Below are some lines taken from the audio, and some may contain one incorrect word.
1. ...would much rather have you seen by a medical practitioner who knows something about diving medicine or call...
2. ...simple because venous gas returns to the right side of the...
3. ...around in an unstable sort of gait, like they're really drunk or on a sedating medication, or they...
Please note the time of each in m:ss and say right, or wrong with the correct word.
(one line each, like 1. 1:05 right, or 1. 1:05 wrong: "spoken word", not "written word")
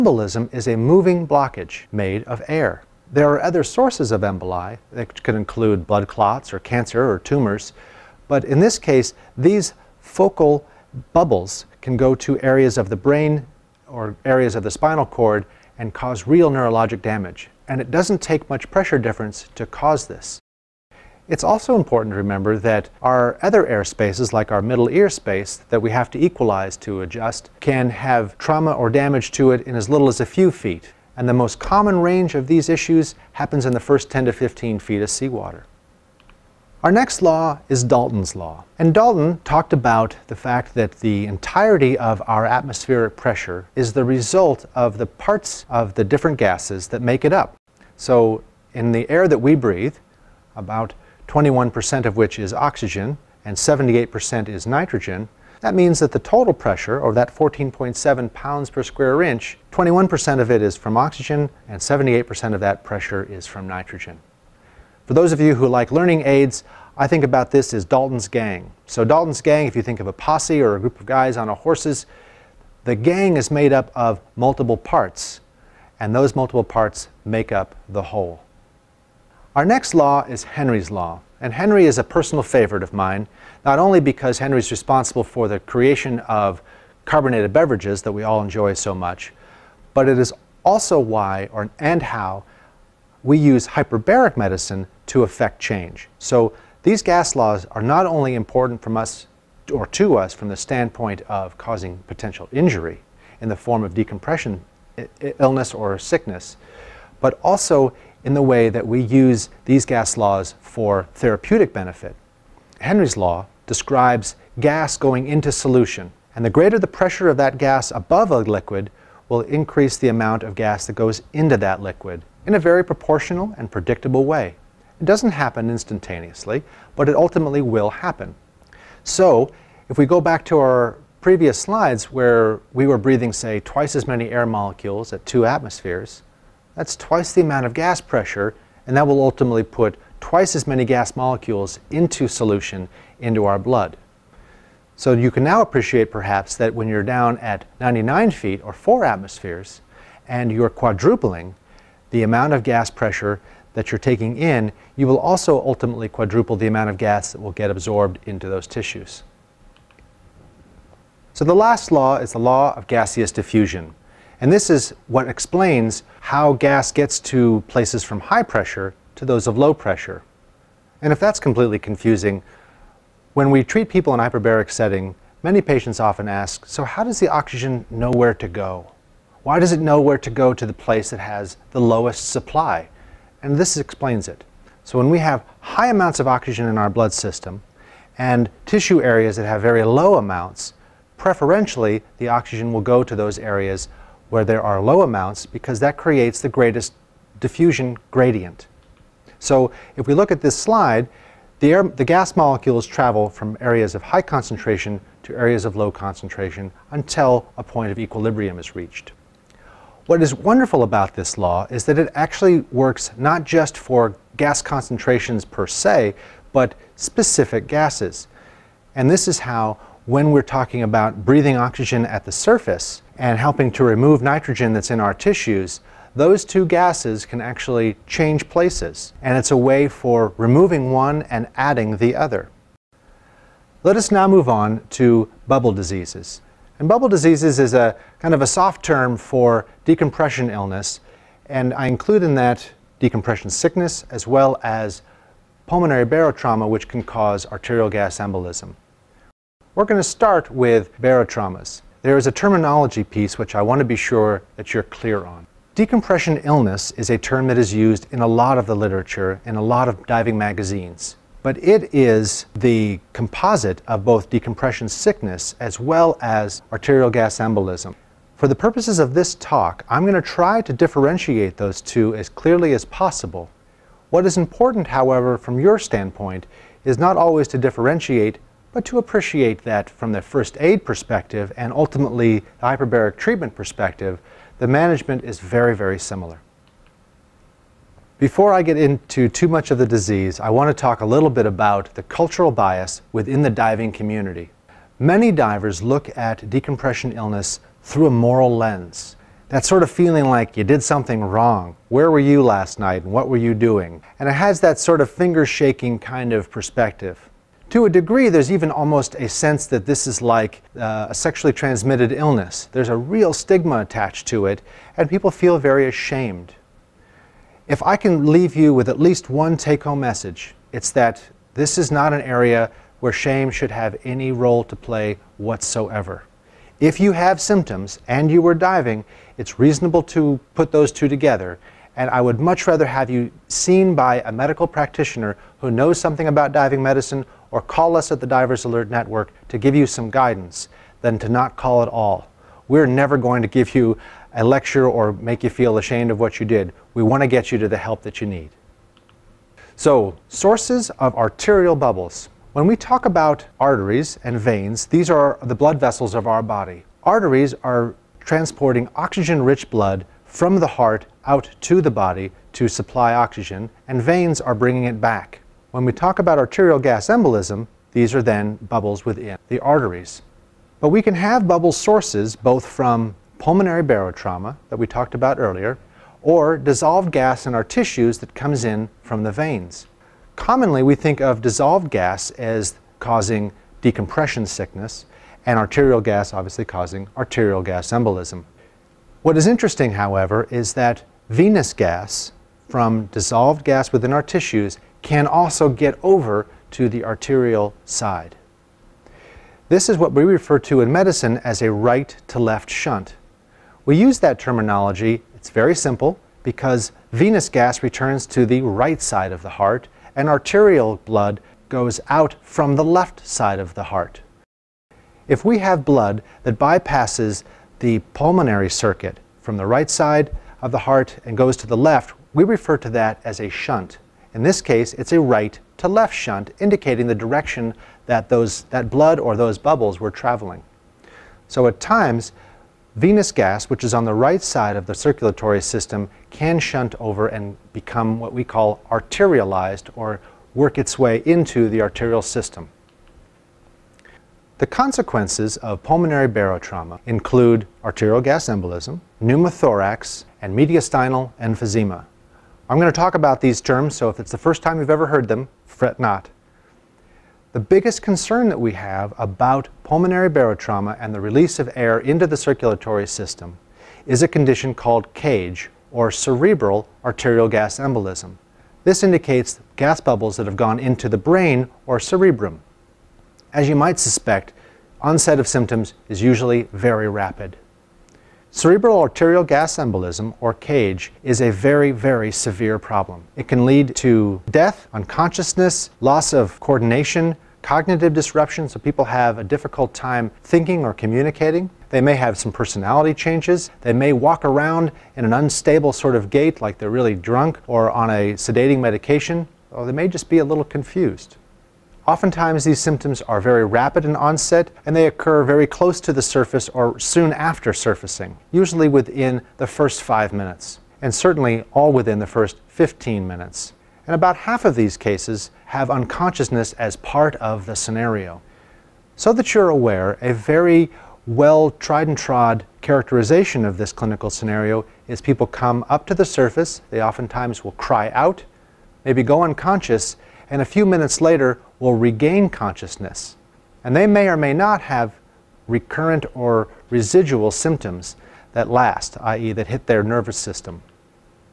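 1. 5:32 right
2. 6:45 right
3. 8:14 right.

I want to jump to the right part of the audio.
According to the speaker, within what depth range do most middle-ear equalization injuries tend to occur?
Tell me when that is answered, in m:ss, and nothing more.
0:33.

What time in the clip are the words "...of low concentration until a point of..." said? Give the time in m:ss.
3:25.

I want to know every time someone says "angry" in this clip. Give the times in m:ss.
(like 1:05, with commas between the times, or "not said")
not said.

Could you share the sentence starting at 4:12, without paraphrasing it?
There is a terminology piece which I want to be sure that you're clear on.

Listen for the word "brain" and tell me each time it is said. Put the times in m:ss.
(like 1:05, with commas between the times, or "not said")
0:12, 7:51.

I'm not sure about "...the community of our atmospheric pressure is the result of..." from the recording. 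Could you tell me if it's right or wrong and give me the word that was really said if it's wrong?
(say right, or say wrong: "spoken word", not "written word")
wrong: "entirety", not "community".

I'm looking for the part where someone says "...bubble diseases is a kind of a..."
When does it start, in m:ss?
3:56.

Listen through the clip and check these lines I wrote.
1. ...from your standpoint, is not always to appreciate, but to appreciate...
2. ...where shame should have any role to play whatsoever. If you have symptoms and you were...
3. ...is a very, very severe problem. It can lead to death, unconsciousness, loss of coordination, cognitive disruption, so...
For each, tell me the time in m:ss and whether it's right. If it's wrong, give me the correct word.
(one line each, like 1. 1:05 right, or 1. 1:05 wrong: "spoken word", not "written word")
1. 4:35 wrong: "differentiate", not "appreciate"
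2. 5:22 right
3. 8:01 right.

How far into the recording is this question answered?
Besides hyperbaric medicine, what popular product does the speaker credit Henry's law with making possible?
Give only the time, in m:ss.
1:27.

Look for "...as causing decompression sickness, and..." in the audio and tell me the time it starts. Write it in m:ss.
6:22.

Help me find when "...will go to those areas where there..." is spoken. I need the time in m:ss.
3:12.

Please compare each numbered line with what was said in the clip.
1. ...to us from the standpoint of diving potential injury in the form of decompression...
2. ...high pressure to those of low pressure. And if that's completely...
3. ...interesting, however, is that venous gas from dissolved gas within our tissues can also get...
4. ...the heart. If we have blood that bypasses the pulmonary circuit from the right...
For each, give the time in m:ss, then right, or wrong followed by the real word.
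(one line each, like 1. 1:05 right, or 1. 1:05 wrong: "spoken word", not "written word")
1. 1:39 wrong: "causing", not "diving"
2. 2:48 right
3. 6:29 right
4. 6:53 right.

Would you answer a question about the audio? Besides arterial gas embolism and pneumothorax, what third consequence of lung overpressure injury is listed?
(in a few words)
mediastinal emphysema.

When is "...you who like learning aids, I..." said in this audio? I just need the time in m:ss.
1:05.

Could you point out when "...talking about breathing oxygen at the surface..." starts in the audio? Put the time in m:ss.
3:40.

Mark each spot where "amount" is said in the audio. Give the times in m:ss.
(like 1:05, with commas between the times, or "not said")
2:00, 2:17, 2:32, 2:36, 3:05, 3:10, 3:15.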